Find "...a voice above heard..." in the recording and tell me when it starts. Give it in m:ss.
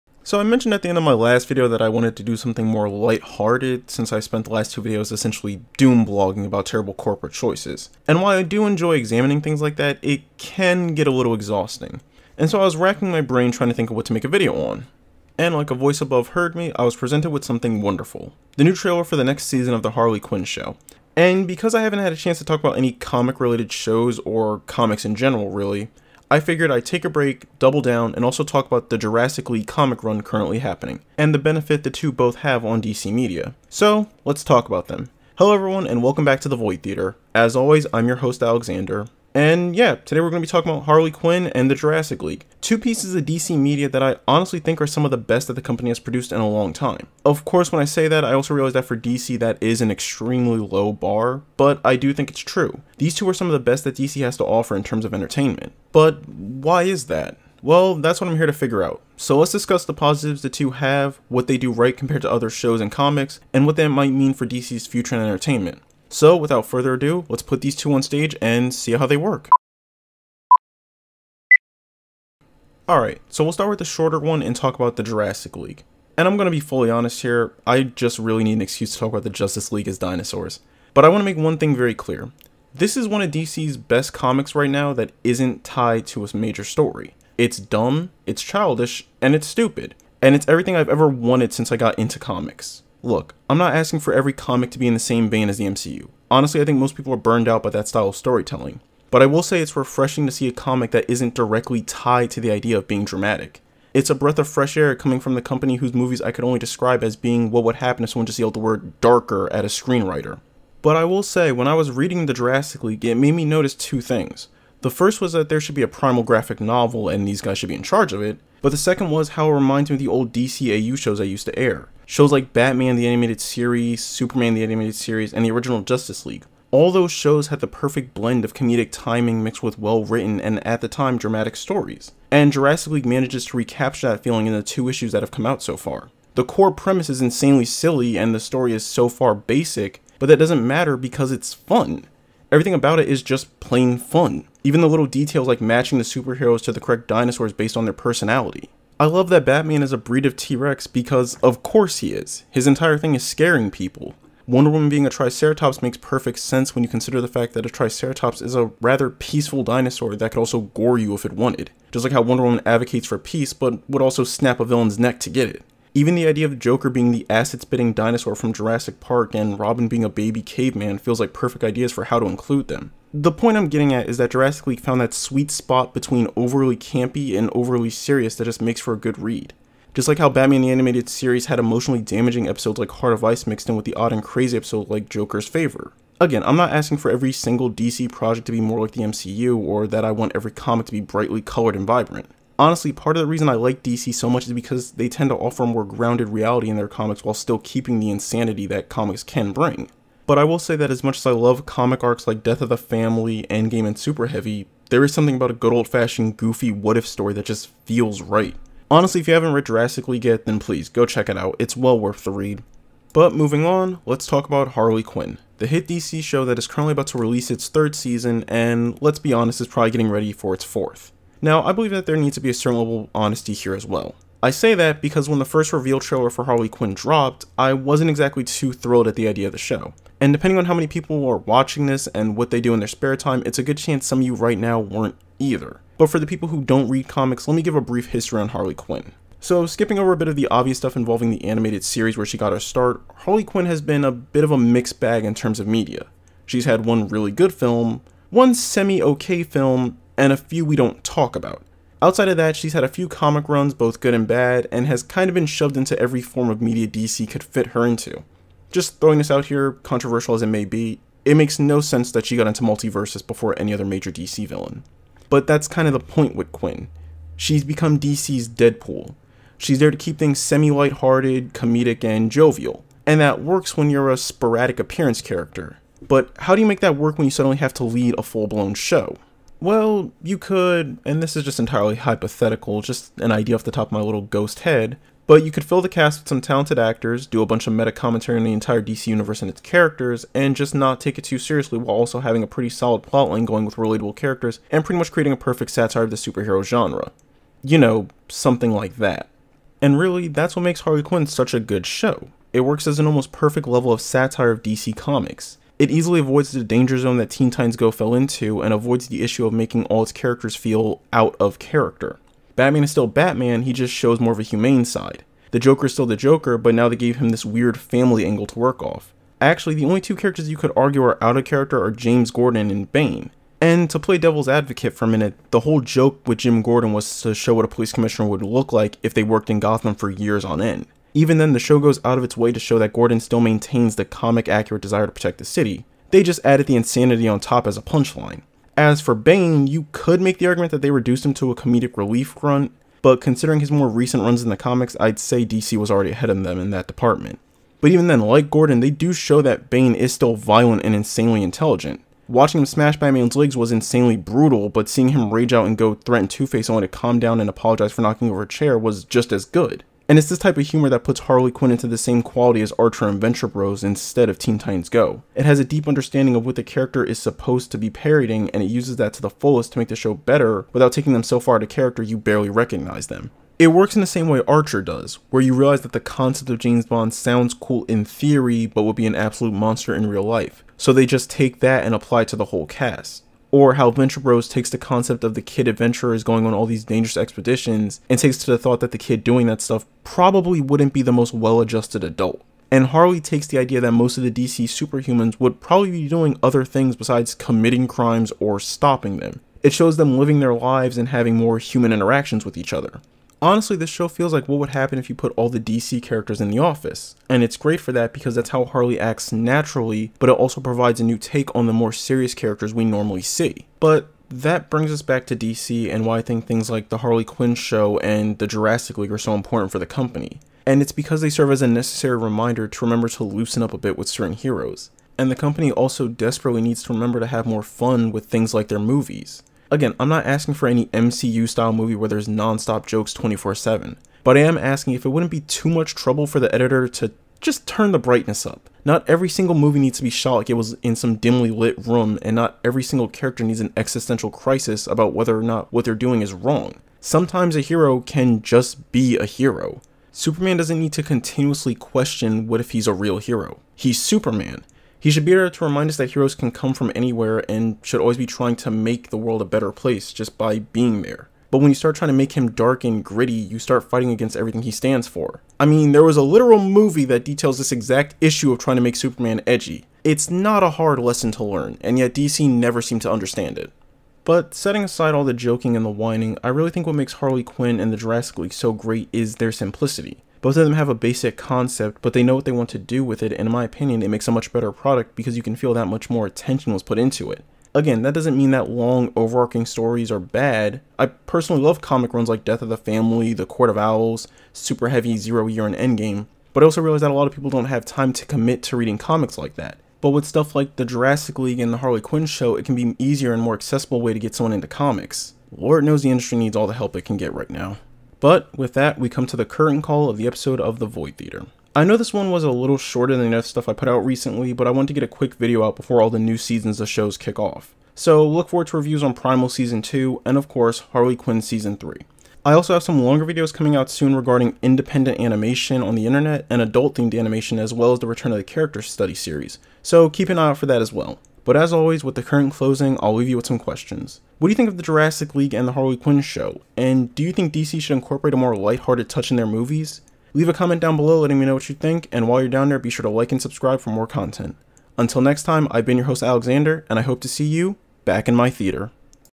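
0:15.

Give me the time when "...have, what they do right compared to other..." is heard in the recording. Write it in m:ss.
1:00.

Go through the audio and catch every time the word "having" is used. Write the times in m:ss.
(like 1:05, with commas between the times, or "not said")
4:52, 6:41.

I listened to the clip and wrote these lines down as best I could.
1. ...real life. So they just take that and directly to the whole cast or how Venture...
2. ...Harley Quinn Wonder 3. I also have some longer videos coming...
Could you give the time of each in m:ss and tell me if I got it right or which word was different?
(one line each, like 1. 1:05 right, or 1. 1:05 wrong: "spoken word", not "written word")
1. 6:20 wrong: "apply", not "directly"
2. 8:40 wrong: "Season", not "Wonder".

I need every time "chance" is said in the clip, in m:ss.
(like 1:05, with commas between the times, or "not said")
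0:22, 3:53.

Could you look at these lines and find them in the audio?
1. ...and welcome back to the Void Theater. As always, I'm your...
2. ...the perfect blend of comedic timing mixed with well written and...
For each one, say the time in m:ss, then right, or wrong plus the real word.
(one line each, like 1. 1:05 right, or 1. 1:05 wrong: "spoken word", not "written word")
1. 0:35 right
2. 2:07 right.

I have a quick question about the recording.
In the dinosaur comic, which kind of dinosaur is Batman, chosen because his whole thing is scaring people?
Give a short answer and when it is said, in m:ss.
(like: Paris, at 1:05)
T Rex, at 2:30.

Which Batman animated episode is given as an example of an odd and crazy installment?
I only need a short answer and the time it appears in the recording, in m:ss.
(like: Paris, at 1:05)
Joker's Favor, at 3:05.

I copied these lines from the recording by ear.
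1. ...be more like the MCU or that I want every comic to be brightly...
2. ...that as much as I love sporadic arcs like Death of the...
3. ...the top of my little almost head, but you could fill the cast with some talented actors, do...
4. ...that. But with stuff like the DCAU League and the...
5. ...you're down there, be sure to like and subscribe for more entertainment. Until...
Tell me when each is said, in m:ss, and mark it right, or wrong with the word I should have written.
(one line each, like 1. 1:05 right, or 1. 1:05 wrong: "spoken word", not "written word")
1. 3:08 right
2. 3:20 wrong: "comic", not "sporadic"
3. 4:43 wrong: "ghost", not "almost"
4. 8:19 wrong: "Jurassic", not "DCAU"
5. 9:02 wrong: "content", not "entertainment".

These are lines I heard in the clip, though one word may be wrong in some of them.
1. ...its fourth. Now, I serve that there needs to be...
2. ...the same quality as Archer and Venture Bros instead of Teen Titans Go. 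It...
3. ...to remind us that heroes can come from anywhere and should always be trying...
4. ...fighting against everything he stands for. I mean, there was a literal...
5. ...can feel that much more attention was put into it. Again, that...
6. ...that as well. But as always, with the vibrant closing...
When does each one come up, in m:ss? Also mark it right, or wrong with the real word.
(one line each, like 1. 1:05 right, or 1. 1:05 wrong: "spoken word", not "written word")
1. 3:40 wrong: "believe", not "serve"
2. 6:01 right
3. 7:35 right
4. 7:43 right
5. 8:05 right
6. 8:50 wrong: "current", not "vibrant".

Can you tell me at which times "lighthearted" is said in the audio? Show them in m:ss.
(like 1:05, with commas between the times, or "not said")
0:02, 4:30, 8:58.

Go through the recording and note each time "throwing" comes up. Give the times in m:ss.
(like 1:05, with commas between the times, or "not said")
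4:18.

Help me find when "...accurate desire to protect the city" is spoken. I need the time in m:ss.
5:34.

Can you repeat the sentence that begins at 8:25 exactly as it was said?
Lord knows the industry needs all the help it can get right now.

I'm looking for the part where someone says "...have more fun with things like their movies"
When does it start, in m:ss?
7:07.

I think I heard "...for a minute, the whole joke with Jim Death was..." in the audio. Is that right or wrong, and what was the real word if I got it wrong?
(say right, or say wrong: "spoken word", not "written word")
wrong: "Gordon", not "Death".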